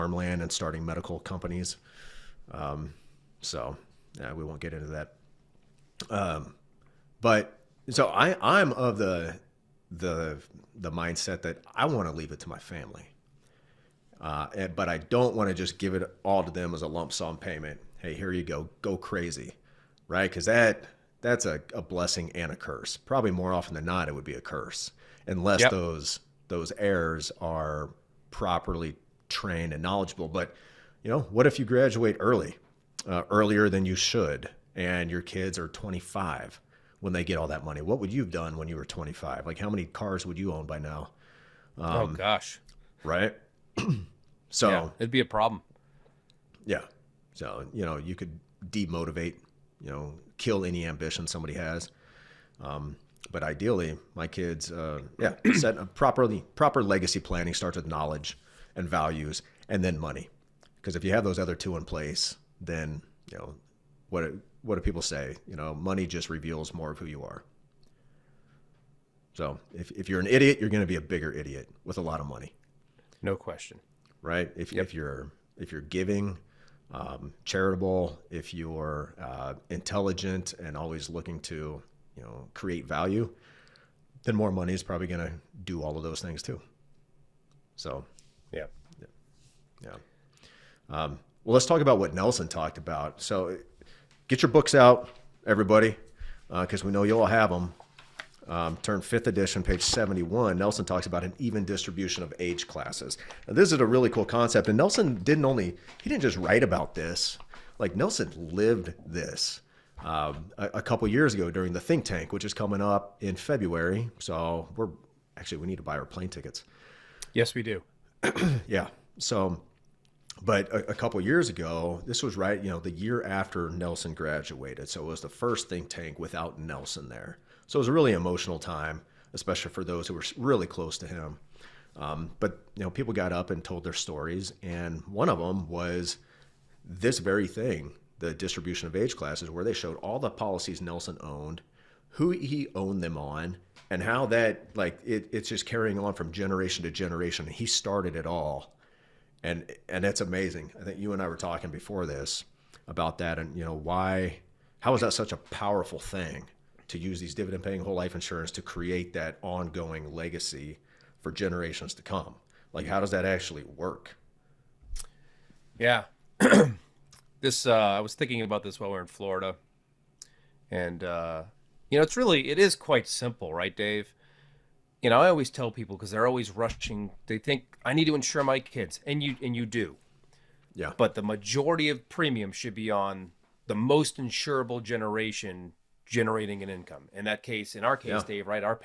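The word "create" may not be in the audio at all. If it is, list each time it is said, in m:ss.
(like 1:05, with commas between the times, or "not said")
1:22, 2:38.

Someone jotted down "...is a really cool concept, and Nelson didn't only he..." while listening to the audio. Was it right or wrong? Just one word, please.
right.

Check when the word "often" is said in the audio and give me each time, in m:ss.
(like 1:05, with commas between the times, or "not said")
0:23.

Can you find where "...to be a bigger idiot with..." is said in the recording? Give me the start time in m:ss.
1:10.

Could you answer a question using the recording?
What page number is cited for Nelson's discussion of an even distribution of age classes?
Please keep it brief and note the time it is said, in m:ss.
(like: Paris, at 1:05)
71, at 1:39.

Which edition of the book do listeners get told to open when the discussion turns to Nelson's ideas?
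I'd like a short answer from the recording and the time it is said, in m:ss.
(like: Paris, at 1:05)
Fifth Edition, at 1:39.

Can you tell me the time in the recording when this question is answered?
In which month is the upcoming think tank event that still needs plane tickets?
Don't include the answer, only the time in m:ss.
1:53.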